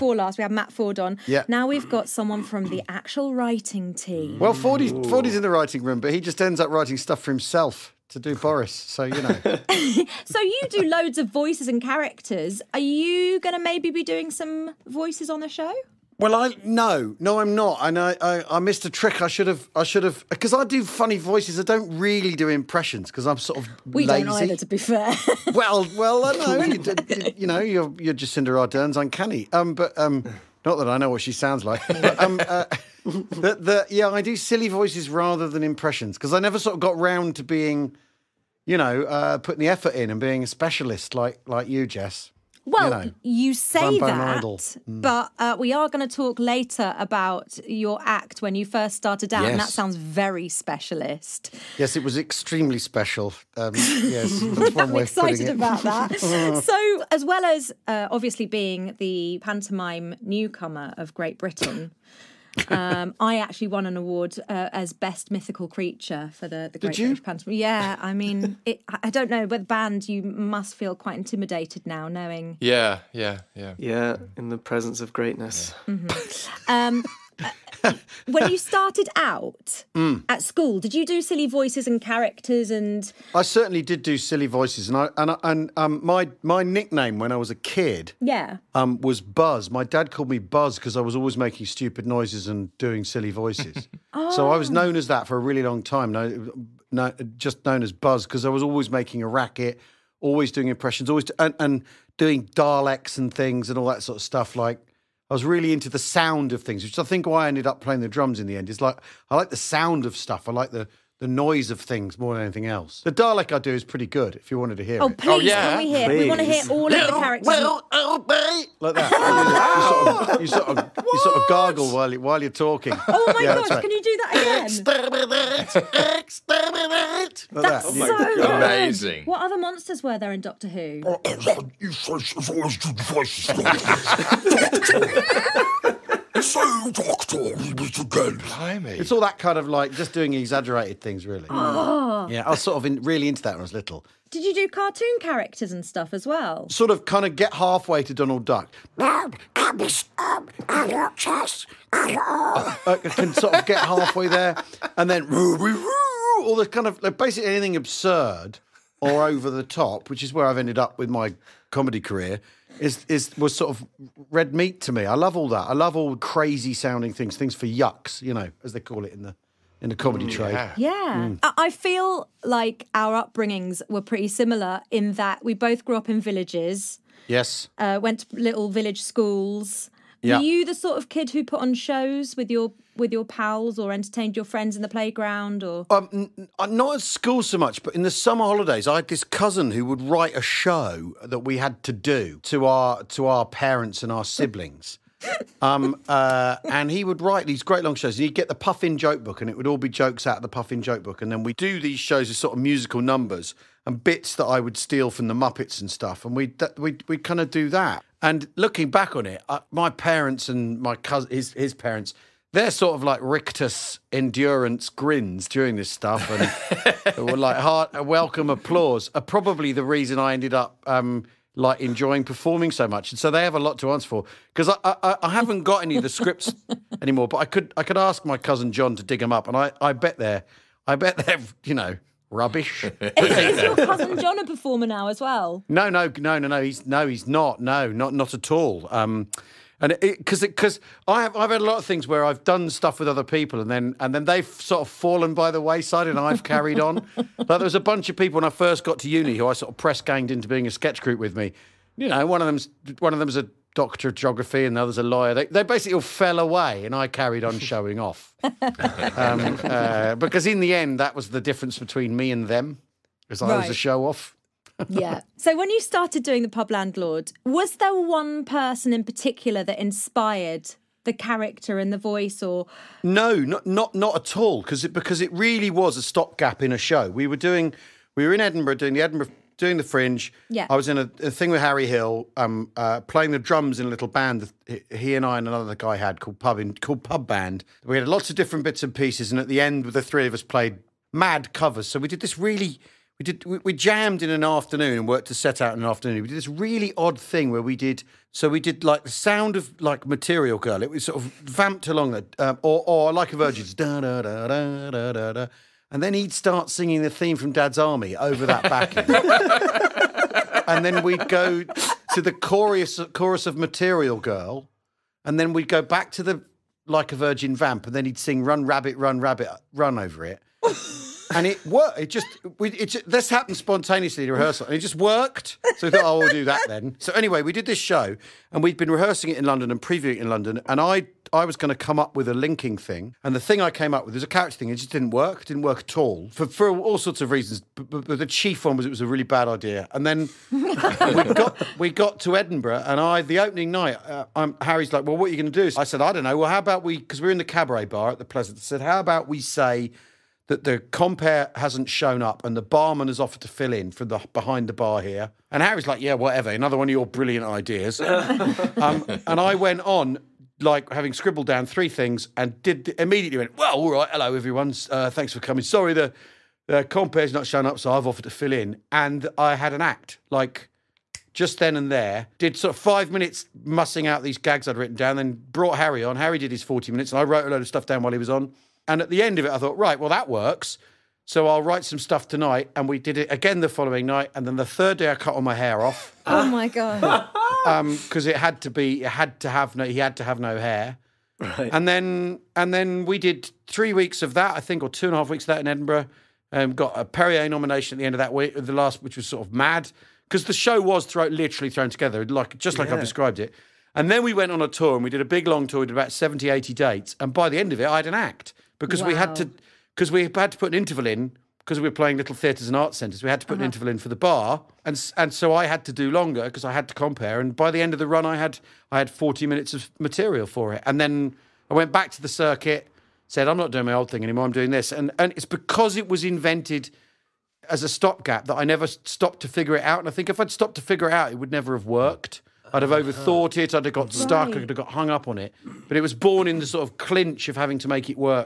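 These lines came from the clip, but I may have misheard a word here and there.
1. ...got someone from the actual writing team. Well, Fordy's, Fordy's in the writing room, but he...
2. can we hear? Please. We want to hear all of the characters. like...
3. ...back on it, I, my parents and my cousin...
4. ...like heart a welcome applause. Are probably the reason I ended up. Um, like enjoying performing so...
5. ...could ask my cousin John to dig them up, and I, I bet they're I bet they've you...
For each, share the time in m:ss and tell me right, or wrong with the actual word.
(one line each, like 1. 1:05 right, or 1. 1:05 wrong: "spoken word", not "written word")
1. 0:01 right
2. 1:55 right
3. 3:28 right
4. 3:37 right
5. 3:47 right.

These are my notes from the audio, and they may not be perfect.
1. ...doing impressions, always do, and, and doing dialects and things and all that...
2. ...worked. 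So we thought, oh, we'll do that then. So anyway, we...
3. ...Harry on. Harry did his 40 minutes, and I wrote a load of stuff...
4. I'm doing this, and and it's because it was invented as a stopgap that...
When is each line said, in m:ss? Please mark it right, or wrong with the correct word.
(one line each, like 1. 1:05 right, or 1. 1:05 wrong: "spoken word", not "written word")
1. 1:40 right
2. 5:24 right
3. 6:15 right
4. 7:04 right.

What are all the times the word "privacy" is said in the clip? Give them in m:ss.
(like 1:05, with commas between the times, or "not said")
not said.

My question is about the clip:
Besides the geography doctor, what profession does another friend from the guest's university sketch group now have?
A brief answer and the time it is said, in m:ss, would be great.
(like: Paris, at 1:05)
Lawyer, at 4:15.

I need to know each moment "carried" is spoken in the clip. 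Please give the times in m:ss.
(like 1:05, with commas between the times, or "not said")
4:06, 4:17.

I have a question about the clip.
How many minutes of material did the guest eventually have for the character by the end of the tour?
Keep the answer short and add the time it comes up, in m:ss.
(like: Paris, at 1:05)
40, at 6:59.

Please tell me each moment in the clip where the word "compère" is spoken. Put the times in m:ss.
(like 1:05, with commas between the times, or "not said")
5:50, 6:06, 6:56.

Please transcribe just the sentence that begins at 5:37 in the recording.
But, but, the chief one was it was a really bad idea.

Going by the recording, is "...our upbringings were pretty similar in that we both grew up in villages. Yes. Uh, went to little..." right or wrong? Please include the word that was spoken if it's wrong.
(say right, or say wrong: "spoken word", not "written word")
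right.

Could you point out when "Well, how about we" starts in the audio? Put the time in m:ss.
5:46.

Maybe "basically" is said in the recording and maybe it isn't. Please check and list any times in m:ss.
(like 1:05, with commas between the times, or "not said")
2:37, 4:15.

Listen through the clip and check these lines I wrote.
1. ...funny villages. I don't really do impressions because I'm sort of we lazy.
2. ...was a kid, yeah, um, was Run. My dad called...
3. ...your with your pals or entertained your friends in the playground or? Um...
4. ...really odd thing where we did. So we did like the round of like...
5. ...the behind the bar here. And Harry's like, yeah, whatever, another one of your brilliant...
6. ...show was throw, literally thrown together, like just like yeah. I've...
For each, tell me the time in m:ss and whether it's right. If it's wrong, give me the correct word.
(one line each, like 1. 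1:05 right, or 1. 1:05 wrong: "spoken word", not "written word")
1. 0:20 wrong: "voices", not "villages"
2. 1:27 wrong: "Buzz", not "Run"
3. 3:02 right
4. 4:56 wrong: "sound", not "round"
5. 5:54 right
6. 6:40 right.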